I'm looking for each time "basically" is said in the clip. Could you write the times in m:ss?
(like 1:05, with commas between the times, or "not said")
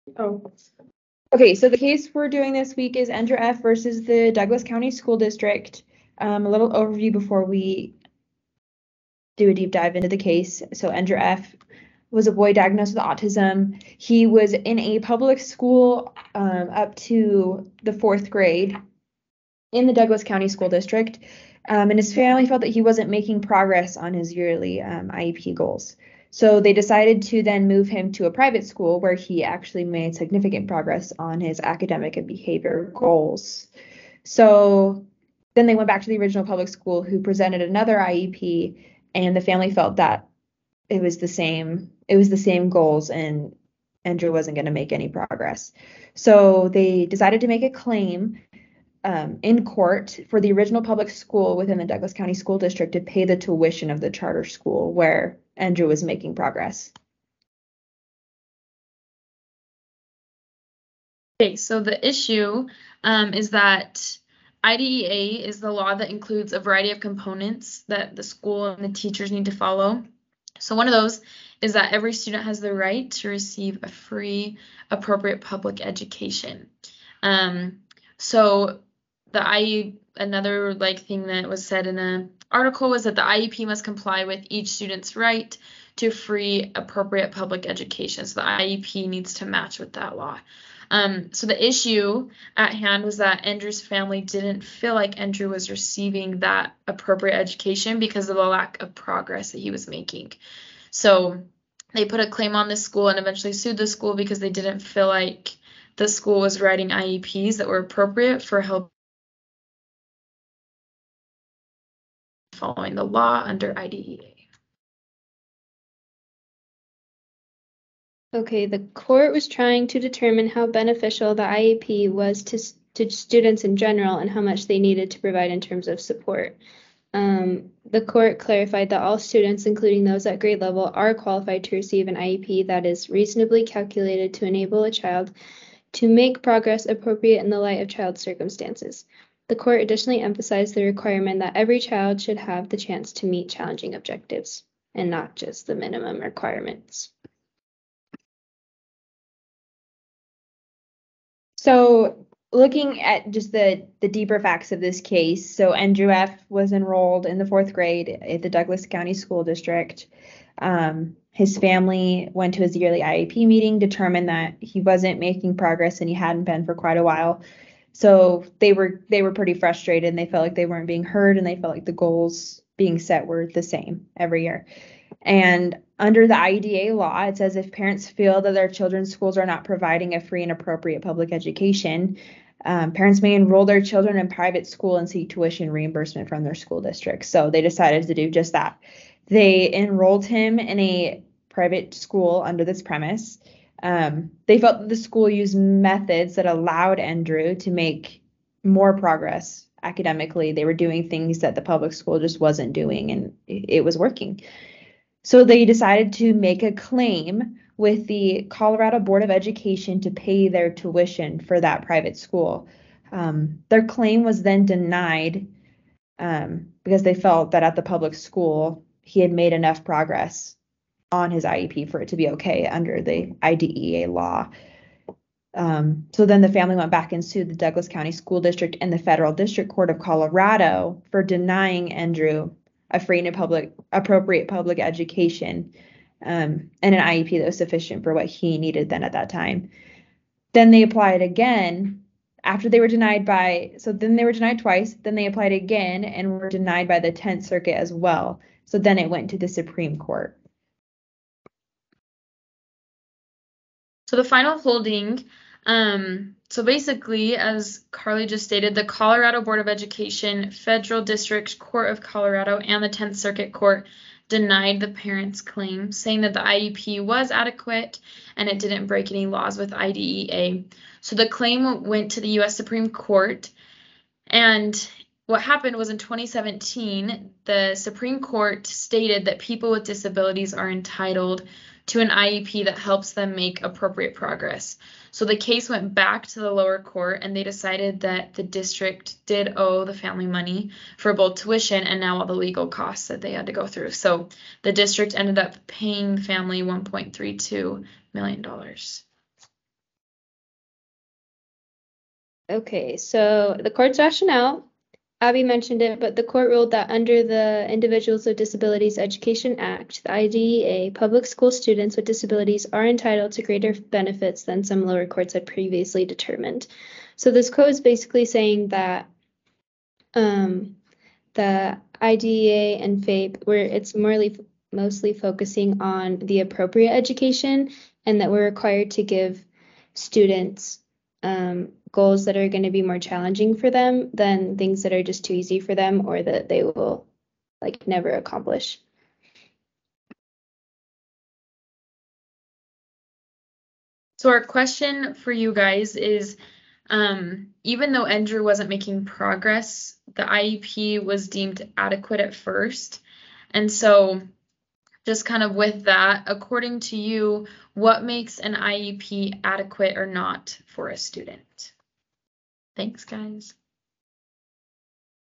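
4:16, 5:17.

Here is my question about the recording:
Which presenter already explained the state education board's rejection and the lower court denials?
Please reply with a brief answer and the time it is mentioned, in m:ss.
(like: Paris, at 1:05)
Carly, at 4:17.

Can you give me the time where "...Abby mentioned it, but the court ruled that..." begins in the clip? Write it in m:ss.
5:05.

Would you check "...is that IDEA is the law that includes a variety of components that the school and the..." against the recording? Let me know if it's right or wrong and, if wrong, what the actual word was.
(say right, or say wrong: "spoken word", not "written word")
right.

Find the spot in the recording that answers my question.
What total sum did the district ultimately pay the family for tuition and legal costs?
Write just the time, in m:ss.
4:56.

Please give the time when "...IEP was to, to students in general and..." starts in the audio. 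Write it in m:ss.
2:01.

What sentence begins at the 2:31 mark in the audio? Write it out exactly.
So looking at just the, the deeper facts of this case, so Andrew F.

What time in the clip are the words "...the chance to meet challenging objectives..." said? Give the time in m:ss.
2:22.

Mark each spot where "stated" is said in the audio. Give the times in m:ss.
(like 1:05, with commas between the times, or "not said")
4:18, 4:38.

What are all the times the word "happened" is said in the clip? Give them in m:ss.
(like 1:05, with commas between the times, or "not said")
4:35.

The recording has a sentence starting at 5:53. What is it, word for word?
And so just kind of with that, according to you, what makes an IEP adequate or not for a student?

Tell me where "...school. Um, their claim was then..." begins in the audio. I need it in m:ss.
3:32.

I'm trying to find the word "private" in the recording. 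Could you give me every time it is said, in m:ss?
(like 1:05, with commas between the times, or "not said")
0:28, 3:04, 3:11, 3:31.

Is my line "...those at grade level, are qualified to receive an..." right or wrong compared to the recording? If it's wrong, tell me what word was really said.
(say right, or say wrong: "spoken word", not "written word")
right.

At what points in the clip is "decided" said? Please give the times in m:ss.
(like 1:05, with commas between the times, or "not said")
0:26, 0:47, 3:07, 3:25, 4:47.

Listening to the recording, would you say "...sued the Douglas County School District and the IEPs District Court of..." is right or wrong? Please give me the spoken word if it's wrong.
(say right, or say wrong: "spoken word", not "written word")
wrong: "Federal", not "IEPs".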